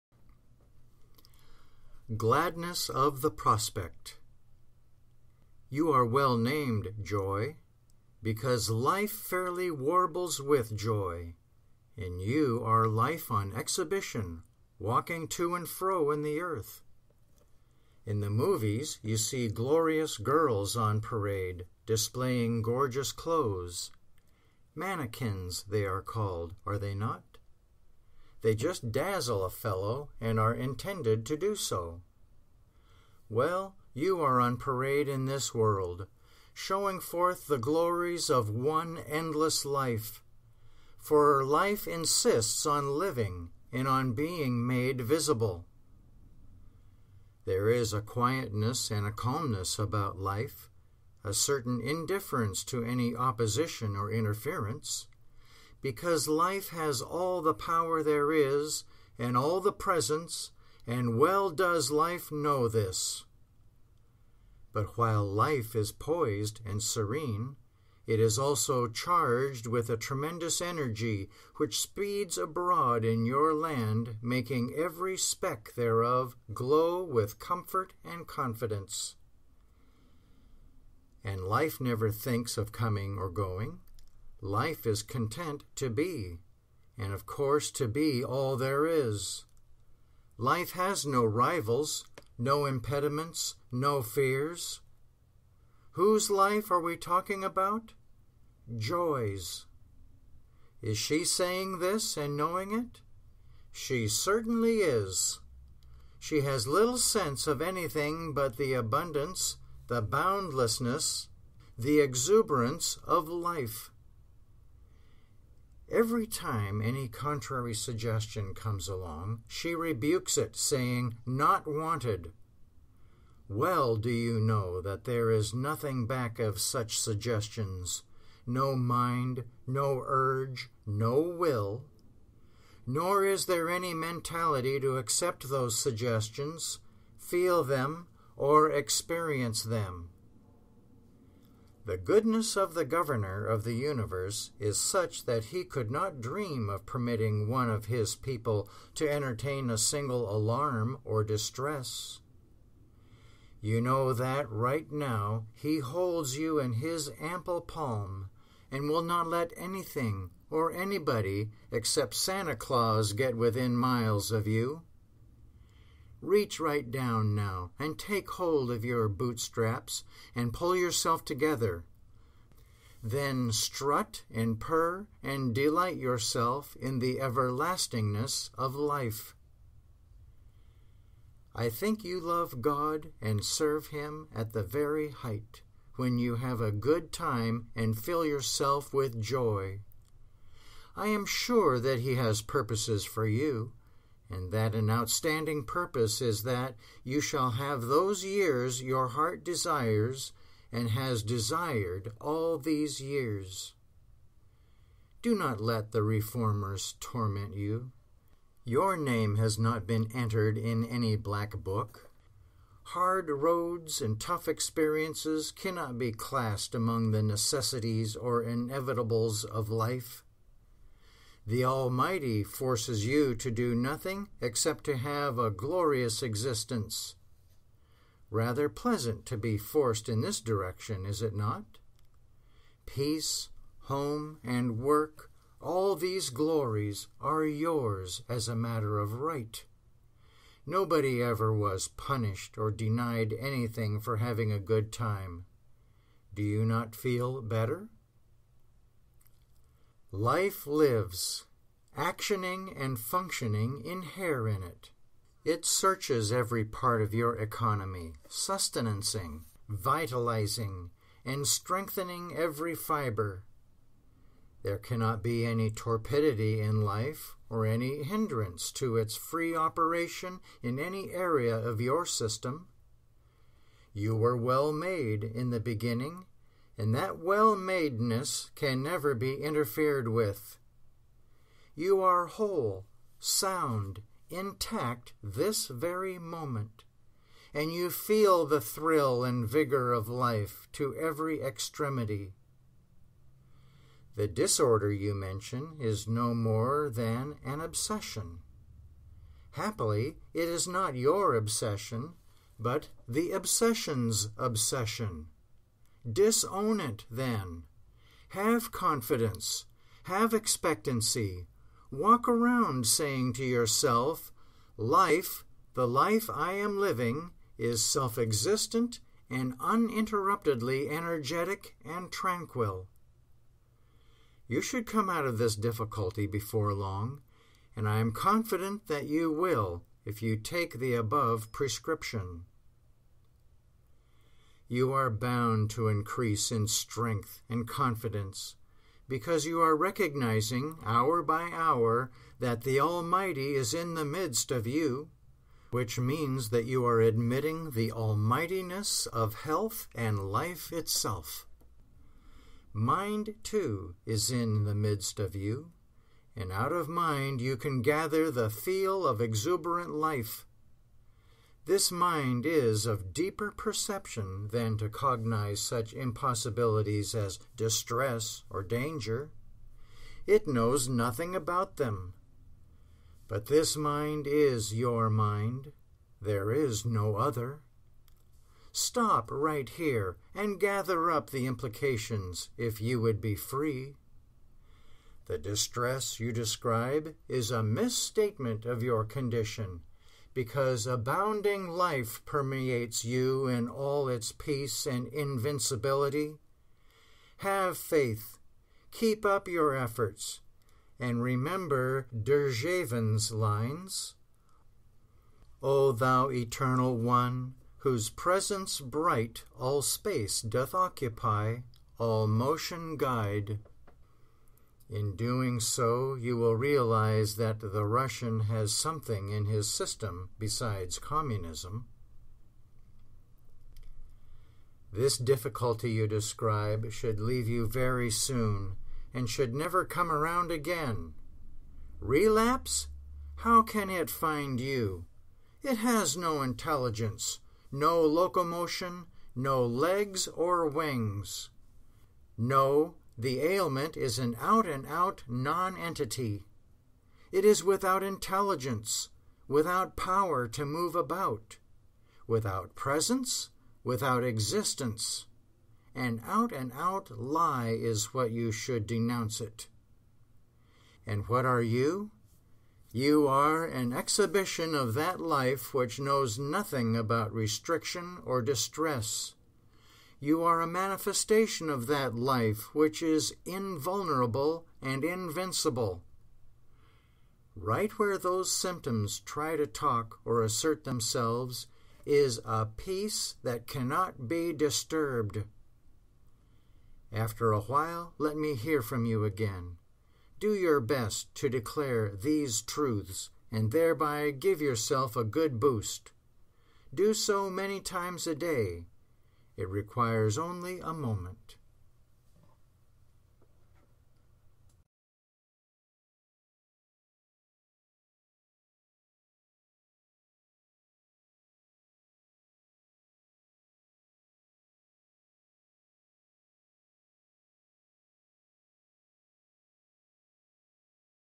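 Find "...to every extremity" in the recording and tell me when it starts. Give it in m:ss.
4:50.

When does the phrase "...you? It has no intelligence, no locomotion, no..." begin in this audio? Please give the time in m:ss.
7:14.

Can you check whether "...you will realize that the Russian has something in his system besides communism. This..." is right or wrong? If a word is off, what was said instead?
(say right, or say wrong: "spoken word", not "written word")
right.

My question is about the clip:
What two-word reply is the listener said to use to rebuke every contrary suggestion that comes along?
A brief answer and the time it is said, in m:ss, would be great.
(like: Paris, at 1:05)
Not wanted, at 2:01.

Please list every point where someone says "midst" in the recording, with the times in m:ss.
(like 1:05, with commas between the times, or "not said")
5:44, 5:54.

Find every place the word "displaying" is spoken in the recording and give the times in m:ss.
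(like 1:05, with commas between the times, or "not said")
0:21.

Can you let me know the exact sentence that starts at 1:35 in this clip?
Whose life are we talking about?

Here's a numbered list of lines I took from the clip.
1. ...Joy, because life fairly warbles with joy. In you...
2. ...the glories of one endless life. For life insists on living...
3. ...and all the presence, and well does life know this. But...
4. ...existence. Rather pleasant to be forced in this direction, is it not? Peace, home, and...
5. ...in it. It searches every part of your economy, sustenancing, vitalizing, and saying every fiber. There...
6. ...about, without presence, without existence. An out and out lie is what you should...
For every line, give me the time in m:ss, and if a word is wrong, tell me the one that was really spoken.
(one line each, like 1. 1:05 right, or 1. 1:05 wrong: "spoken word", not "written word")
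1. 0:07 right
2. 0:37 right
3. 0:59 right
4. 3:46 right
5. 4:14 wrong: "strengthening", not "saying"
6. 7:30 right.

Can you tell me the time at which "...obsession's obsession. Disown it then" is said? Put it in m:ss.
5:03.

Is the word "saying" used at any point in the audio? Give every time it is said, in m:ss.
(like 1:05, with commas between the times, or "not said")
1:41, 2:00, 5:12.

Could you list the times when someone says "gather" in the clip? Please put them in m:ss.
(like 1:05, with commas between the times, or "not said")
5:57, 6:20.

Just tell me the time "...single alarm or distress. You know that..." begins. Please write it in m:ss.
2:29.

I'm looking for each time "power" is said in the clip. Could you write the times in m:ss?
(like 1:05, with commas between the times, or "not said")
0:57, 7:29.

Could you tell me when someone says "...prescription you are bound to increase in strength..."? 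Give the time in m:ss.
5:31.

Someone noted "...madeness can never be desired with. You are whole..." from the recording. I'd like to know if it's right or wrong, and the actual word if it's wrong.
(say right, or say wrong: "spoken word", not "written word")
wrong: "interfered", not "desired".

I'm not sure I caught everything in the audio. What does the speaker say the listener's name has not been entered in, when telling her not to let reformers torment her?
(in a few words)
black book.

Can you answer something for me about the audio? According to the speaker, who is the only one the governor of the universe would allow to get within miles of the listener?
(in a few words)
Santa Claus.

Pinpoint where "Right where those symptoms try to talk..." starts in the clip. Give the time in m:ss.
7:57.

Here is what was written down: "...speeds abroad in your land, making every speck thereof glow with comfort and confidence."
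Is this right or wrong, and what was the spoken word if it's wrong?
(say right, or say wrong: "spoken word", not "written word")
right.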